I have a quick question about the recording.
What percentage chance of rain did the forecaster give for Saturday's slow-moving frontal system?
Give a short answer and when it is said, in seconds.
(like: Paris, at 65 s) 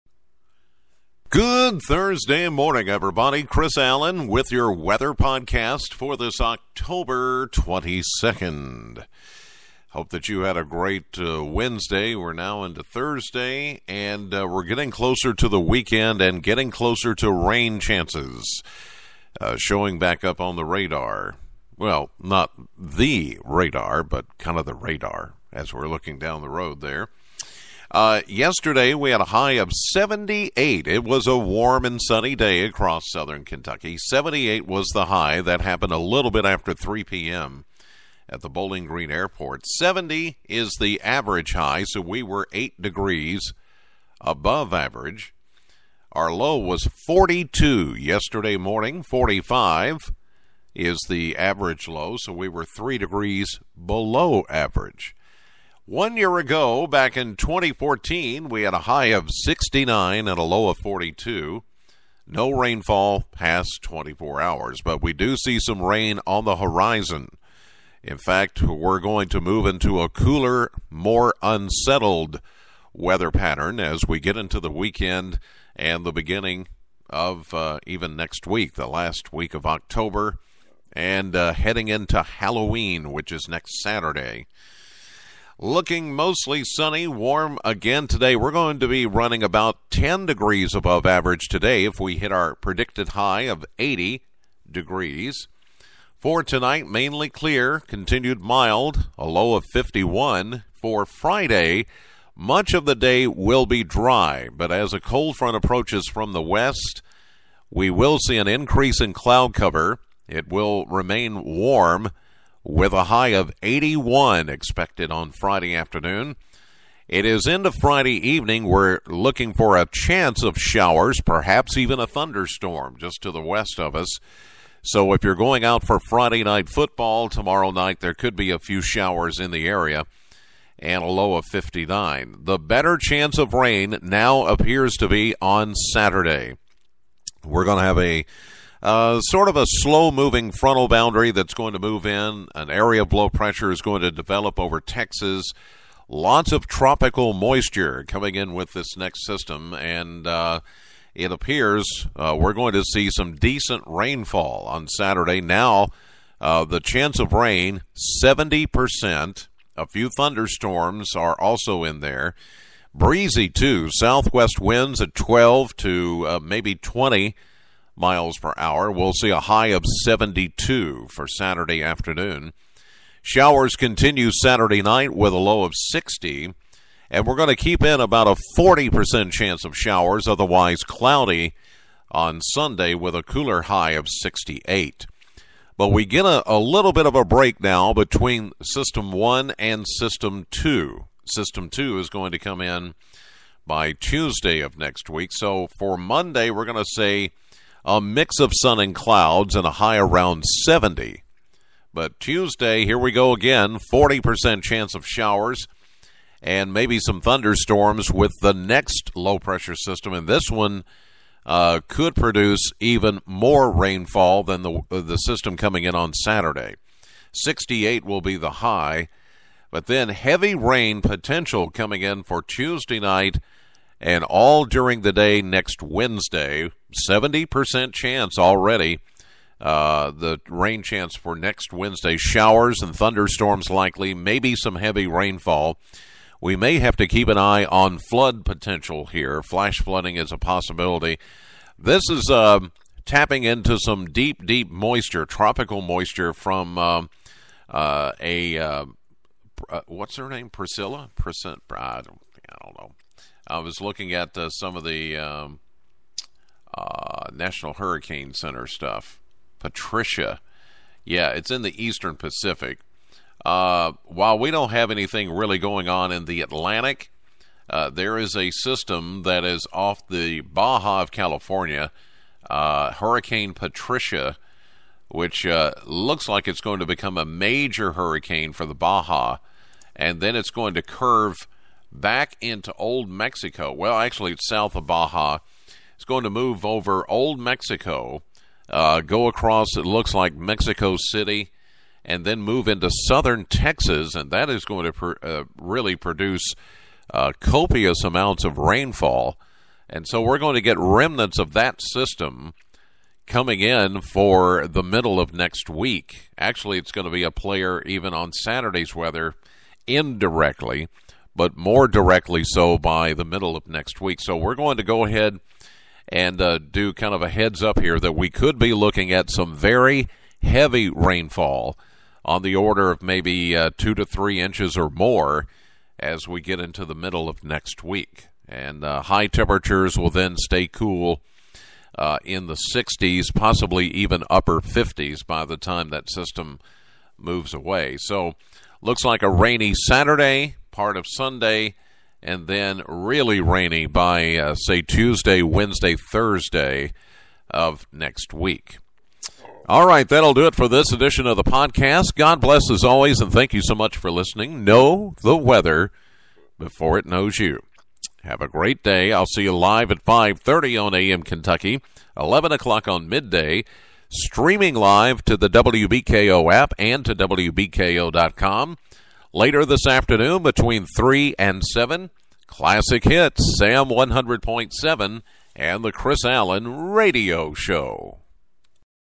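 70%, at 156 s.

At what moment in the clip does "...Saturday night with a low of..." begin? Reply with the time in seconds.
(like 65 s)
174 s.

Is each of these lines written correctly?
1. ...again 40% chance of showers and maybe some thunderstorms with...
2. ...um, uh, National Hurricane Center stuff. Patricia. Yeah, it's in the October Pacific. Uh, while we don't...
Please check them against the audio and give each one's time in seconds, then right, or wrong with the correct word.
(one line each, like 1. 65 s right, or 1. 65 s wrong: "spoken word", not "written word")
1. 203 s right
2. 255 s wrong: "Eastern", not "October".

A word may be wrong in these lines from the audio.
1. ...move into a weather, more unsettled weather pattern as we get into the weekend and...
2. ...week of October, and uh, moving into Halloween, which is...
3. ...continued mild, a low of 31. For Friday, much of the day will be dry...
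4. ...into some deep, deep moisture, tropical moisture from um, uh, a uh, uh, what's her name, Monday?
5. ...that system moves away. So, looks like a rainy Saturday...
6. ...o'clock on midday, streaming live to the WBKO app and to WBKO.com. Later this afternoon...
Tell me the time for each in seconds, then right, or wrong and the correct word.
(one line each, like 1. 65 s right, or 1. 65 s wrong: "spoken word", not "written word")
1. 69 s wrong: "cooler", not "weather"
2. 79 s wrong: "heading", not "moving"
3. 97 s wrong: "51", not "31"
4. 243 s wrong: "Priscilla", not "Monday"
5. 335 s right
6. 362 s right.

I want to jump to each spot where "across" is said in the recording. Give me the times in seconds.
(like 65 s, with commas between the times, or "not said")
32 s, 289 s.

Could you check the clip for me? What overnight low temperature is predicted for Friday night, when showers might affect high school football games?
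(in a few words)
59.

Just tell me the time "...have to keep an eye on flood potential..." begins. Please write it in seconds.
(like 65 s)
236 s.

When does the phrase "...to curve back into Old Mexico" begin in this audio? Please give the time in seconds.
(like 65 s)
280 s.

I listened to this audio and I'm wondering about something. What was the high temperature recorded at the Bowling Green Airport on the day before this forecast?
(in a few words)
78.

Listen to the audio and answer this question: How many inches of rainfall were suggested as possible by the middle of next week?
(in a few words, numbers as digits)
2 to 3 inches.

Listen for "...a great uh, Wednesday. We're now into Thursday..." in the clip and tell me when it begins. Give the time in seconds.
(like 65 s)
10 s.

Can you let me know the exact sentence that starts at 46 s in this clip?
Our low was 42 yesterday morning, 45 is the average low, so we were 3 degrees below average.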